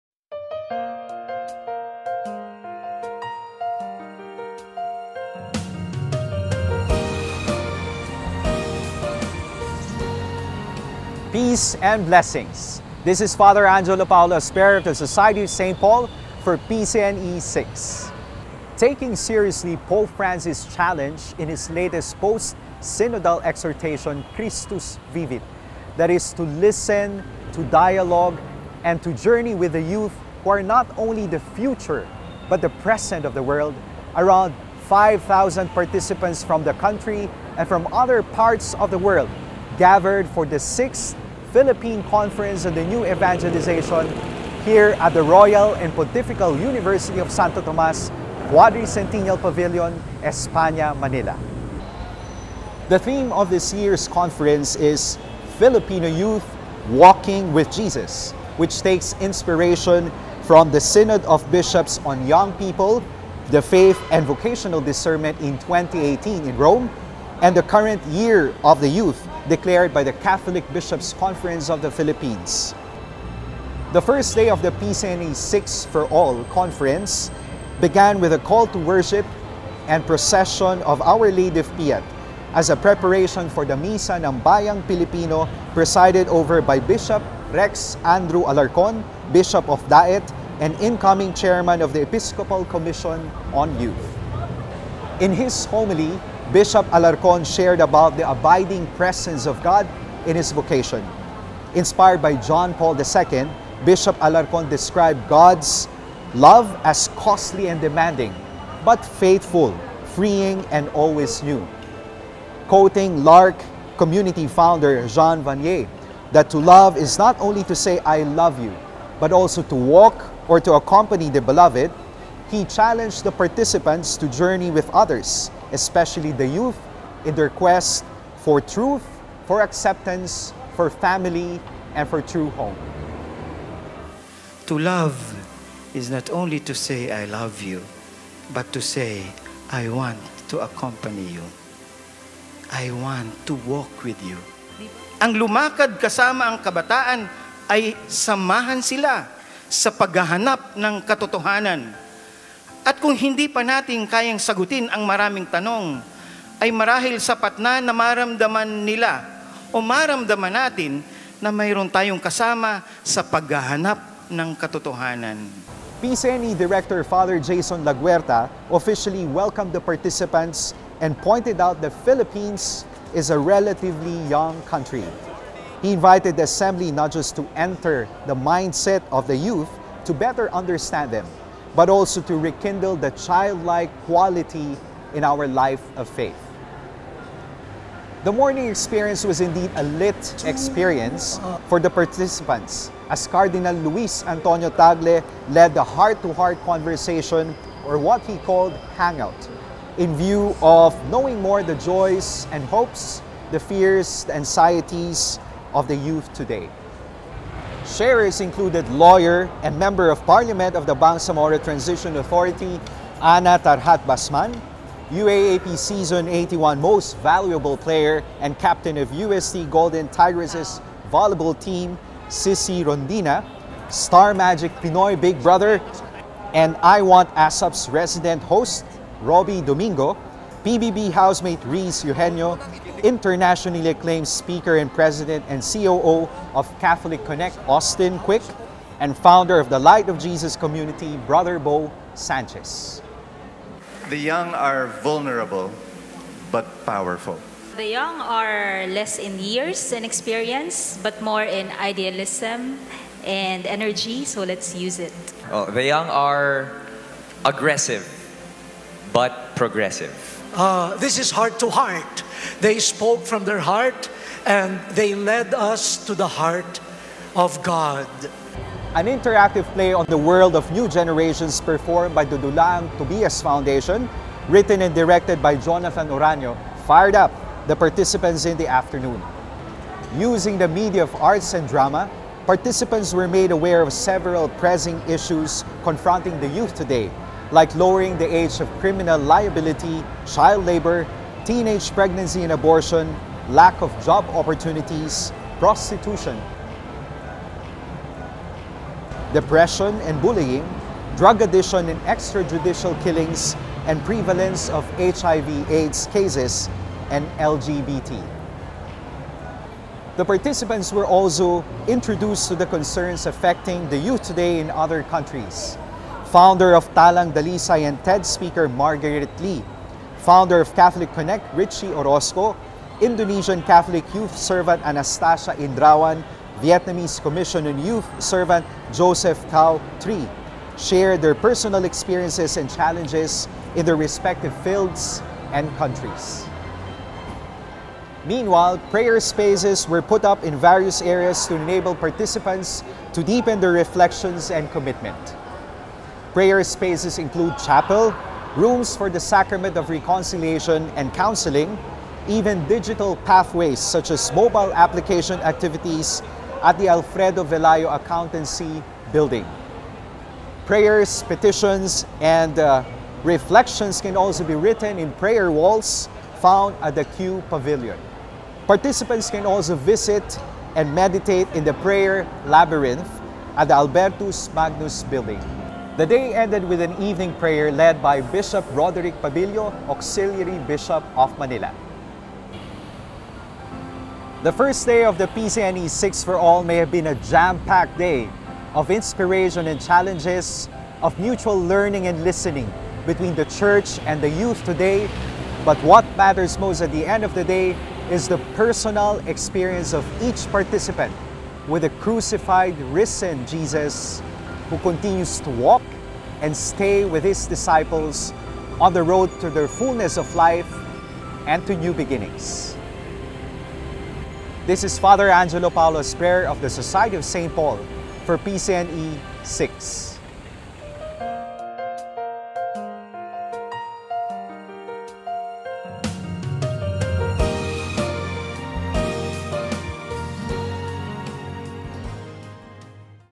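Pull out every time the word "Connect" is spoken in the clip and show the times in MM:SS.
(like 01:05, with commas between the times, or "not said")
03:57, 05:21.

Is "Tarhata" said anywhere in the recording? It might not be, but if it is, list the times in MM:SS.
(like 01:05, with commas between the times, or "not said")
03:33.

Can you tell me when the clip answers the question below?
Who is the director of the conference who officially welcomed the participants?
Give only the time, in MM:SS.
02:47.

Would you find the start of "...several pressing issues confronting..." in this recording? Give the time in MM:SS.
04:43.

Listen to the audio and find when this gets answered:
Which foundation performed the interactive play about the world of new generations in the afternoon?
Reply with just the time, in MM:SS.
04:32.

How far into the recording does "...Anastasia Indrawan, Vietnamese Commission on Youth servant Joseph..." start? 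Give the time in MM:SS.
05:24.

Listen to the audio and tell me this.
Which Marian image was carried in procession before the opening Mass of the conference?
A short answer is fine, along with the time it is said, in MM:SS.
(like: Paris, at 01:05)
Our Lady of Piat, at 01:21.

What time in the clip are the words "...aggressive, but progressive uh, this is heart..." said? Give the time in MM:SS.
04:17.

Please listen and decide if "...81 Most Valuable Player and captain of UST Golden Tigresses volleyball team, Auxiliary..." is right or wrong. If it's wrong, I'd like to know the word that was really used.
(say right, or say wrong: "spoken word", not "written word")
wrong: "Cherry", not "Auxiliary".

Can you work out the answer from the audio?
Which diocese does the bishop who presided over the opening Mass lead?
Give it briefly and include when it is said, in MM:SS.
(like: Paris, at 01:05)
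Daet, at 01:29.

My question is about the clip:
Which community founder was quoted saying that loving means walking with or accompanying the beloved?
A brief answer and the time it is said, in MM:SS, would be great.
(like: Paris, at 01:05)
Jean Vanier, at 01:55.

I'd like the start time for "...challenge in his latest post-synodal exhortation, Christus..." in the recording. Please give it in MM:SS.
00:20.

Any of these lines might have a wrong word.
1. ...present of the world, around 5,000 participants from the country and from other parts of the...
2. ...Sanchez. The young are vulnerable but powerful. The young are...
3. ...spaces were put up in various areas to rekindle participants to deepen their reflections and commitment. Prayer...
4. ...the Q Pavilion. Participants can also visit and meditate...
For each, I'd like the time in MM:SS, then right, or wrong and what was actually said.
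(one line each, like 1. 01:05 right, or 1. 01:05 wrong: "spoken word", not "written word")
1. 00:32 right
2. 04:02 right
3. 05:39 wrong: "enable", not "rekindle"
4. 06:06 right.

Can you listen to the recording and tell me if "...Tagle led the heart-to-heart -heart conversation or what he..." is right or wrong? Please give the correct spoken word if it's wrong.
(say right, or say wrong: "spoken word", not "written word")
right.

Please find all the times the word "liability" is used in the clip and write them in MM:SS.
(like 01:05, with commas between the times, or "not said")
04:49.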